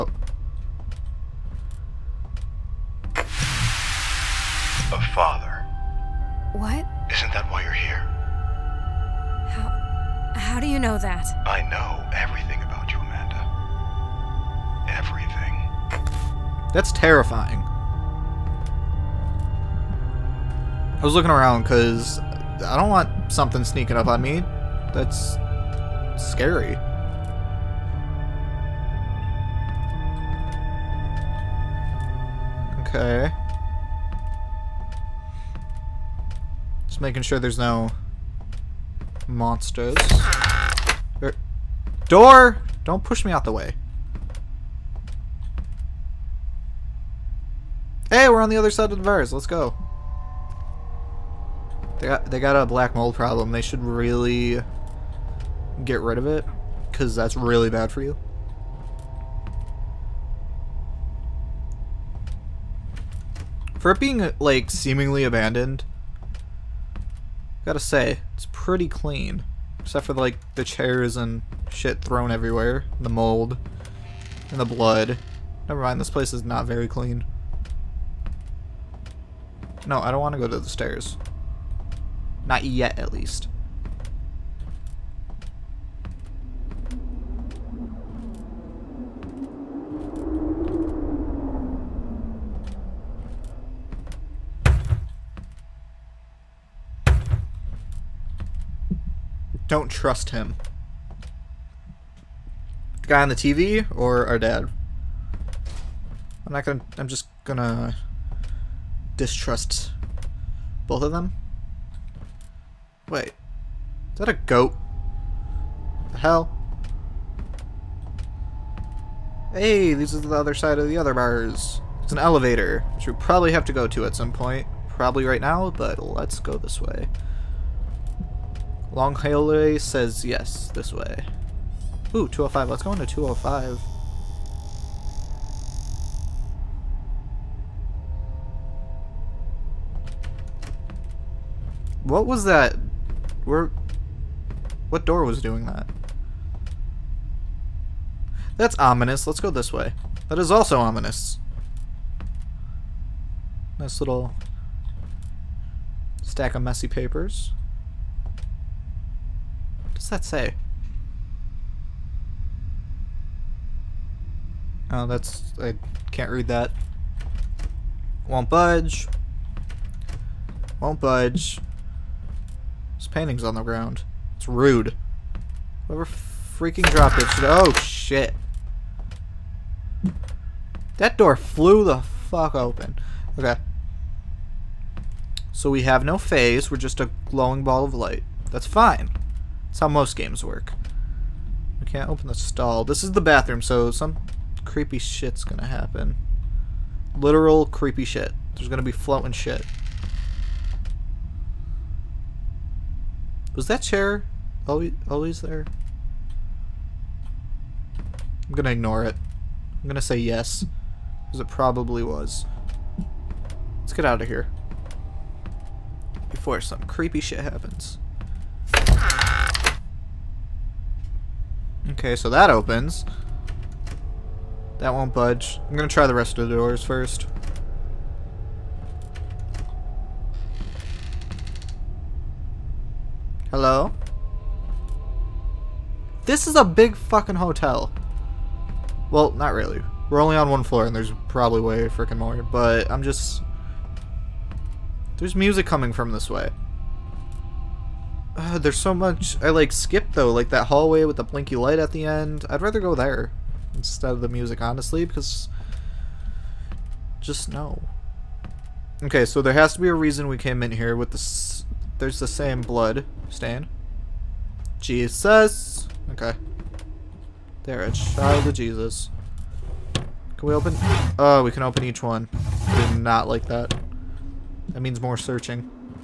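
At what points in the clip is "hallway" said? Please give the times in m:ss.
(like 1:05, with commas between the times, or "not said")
2:09, 4:10.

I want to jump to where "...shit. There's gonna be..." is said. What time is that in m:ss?
3:18.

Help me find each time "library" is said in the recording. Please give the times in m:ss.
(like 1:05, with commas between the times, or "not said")
not said.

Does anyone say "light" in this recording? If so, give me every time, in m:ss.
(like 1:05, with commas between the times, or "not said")
3:07, 4:11.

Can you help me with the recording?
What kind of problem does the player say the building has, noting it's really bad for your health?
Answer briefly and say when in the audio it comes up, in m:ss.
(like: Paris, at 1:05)
black mold, at 0:52.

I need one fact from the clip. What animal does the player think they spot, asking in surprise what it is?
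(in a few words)
goat.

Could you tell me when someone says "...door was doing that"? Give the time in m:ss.
2:25.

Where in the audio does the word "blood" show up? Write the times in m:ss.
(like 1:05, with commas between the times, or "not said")
1:14, 4:22.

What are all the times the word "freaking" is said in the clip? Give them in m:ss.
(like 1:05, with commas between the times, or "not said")
2:56, 4:01.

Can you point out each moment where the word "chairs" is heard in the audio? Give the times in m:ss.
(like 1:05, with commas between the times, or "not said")
1:10, 3:23.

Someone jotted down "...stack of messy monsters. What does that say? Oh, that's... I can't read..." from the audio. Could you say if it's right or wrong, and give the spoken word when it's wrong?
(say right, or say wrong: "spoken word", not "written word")
wrong: "papers", not "monsters".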